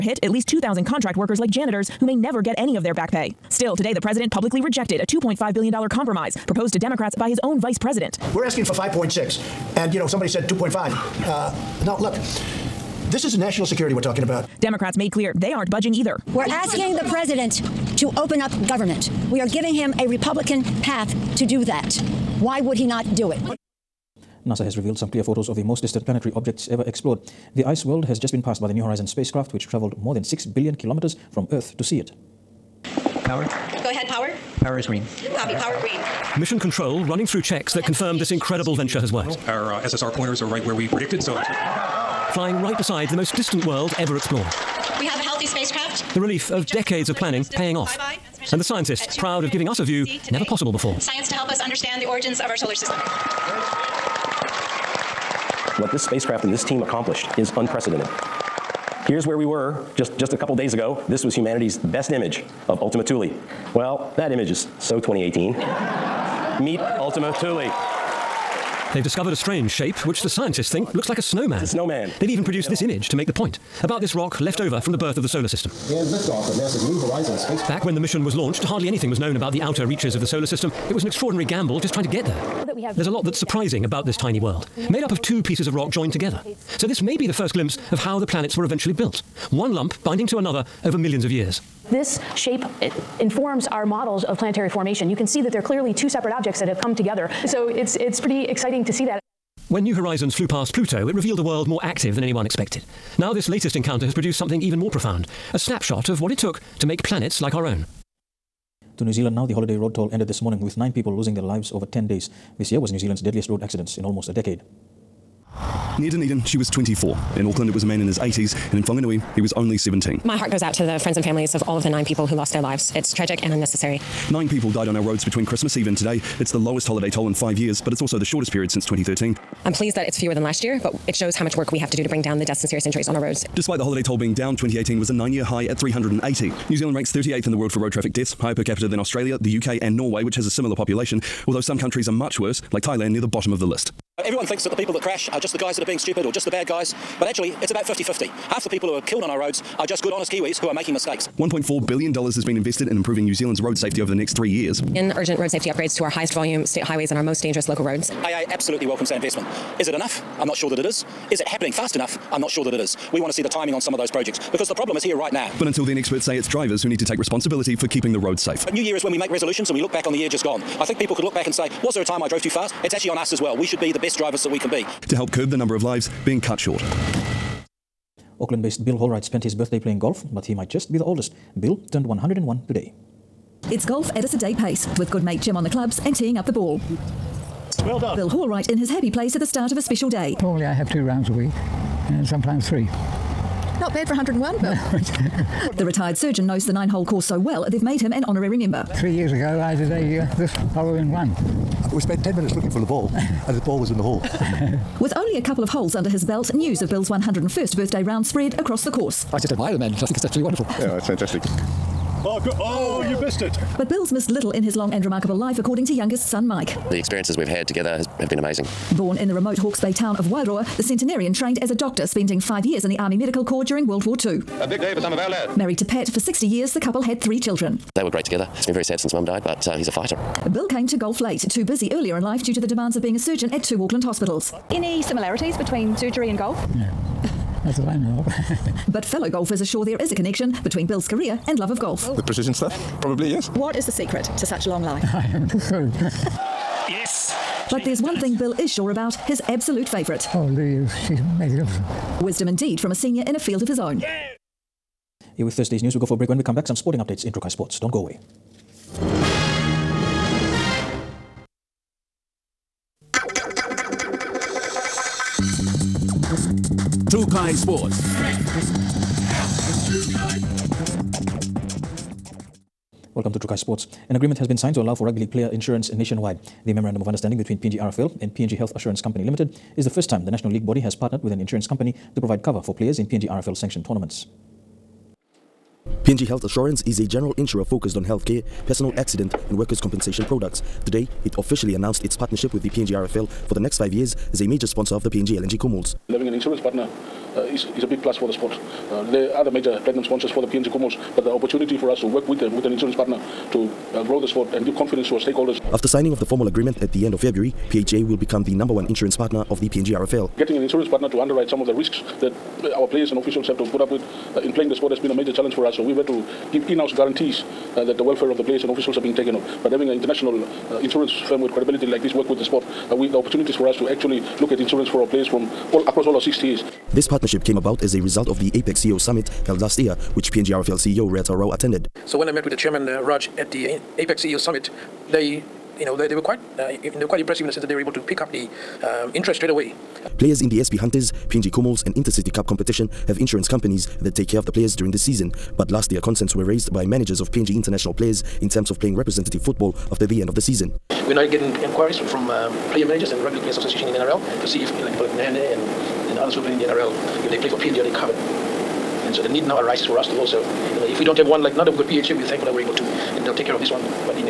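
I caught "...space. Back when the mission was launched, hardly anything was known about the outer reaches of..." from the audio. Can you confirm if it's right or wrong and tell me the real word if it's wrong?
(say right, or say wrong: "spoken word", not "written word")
right.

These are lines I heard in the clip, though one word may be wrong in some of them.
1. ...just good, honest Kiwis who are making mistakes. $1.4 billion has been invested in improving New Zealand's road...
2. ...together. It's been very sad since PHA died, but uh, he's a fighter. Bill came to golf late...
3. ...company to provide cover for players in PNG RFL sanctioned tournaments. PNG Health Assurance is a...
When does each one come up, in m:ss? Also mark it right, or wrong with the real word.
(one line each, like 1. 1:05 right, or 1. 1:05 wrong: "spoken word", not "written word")
1. 2:29 right
2. 3:48 wrong: "Mum", not "PHA"
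3. 4:41 right.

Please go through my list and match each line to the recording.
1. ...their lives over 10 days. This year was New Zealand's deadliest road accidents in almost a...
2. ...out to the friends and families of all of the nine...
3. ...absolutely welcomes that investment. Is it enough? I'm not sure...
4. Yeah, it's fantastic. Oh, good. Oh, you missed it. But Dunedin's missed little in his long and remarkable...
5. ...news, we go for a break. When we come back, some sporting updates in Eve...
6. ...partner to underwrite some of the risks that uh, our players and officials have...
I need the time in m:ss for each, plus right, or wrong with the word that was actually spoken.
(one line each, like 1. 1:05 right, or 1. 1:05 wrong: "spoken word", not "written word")
1. 1:51 right
2. 2:00 right
3. 2:38 right
4. 3:30 wrong: "Bill", not "Dunedin"
5. 4:15 wrong: "Trukai", not "Eve"
6. 5:10 right.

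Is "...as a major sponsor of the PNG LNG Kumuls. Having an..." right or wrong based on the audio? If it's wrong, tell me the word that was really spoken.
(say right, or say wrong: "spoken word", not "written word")
right.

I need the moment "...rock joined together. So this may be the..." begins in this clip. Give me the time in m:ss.
1:25.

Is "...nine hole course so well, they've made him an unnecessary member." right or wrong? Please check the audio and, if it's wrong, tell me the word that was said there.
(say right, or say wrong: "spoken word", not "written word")
wrong: "honorary", not "unnecessary".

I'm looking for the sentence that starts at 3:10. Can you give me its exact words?
Normally I have two rounds a week and sometimes three.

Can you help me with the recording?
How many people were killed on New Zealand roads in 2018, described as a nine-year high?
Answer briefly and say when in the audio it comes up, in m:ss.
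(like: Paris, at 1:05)
380, at 2:15.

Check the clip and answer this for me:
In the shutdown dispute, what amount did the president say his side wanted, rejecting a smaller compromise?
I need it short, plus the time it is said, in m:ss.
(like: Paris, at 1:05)
5.6, at 0:08.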